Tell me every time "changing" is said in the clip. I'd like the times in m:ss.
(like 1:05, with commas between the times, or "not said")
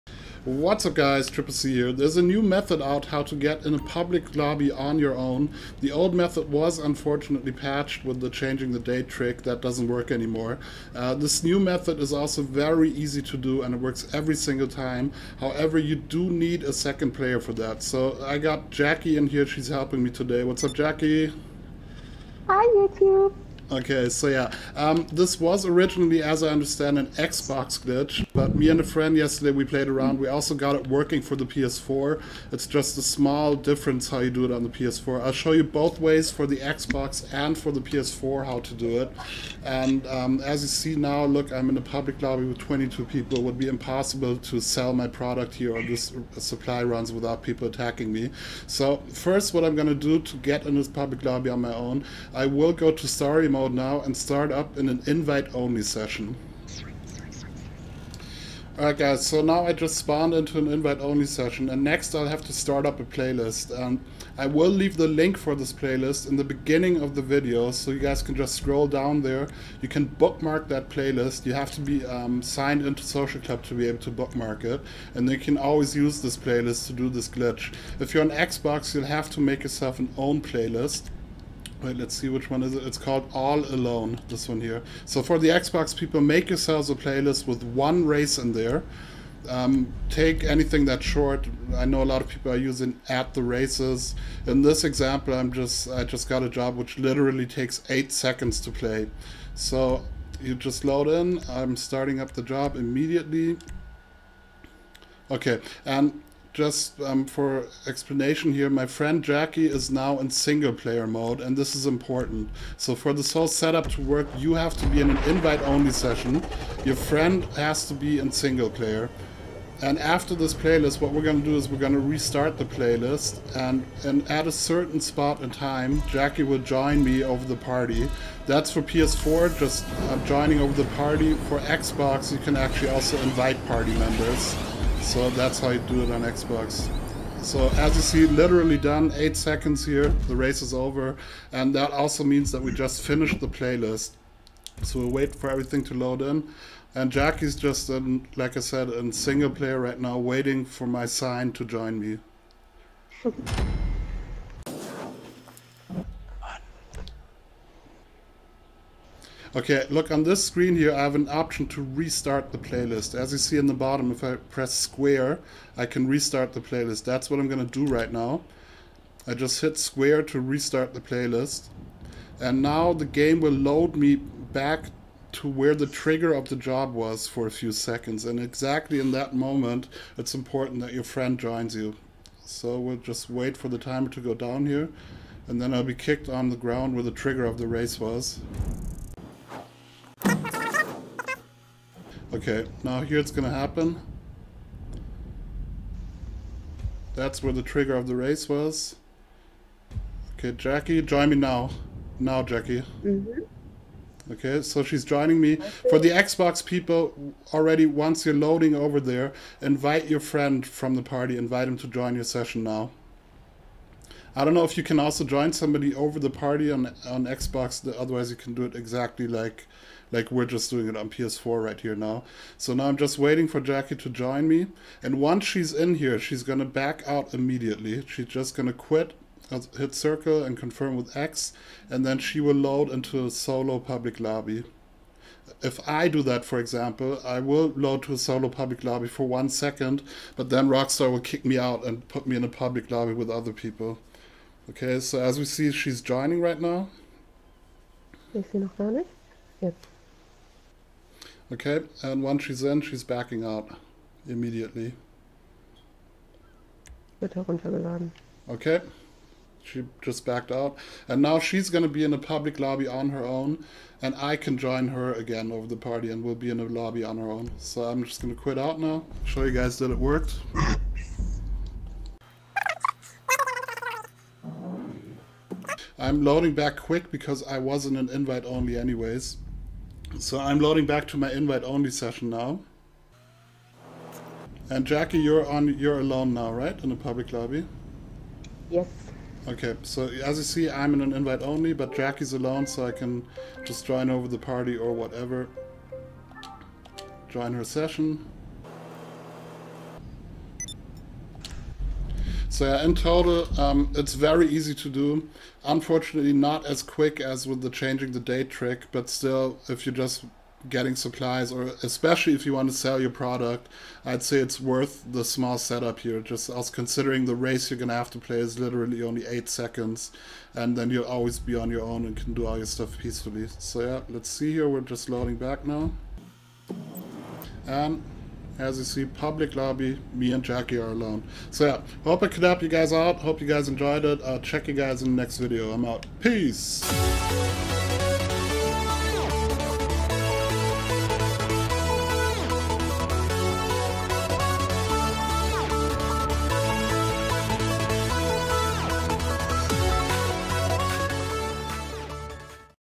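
0:08, 5:07.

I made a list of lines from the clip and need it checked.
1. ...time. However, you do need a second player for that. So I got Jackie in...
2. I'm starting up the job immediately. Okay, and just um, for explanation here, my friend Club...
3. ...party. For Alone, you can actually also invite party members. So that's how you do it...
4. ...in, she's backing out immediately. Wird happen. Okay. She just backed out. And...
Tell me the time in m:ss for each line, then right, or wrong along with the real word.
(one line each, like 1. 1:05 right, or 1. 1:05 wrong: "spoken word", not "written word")
1. 0:14 right
2. 1:41 wrong: "Jackie", not "Club"
3. 2:10 wrong: "Xbox", not "Alone"
4. 4:12 wrong: "heruntergeladen", not "happen".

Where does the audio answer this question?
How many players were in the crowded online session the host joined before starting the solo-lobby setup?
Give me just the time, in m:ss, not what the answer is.
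0:42.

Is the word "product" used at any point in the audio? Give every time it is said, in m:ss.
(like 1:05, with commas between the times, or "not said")
0:45, 5:13.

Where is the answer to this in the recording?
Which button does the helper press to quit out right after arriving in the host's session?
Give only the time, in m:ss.
3:49.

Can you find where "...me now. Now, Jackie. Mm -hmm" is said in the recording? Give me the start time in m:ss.
3:21.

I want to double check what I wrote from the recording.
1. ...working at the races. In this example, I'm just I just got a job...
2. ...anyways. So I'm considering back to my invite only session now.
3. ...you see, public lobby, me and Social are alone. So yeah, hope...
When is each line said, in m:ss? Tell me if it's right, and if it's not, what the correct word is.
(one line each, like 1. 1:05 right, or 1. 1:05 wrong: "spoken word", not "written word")
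1. 1:32 wrong: "using", not "working"
2. 4:38 wrong: "loading", not "considering"
3. 5:28 wrong: "Jackie", not "Social".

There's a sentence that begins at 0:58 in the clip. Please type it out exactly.
Alright guys, so now I just spawned into an invite-only session and next I'll have to start up a playlist.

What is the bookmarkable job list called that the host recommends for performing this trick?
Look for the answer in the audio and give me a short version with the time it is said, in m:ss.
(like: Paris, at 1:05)
All Alone, at 1:23.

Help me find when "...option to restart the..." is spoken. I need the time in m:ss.
2:41.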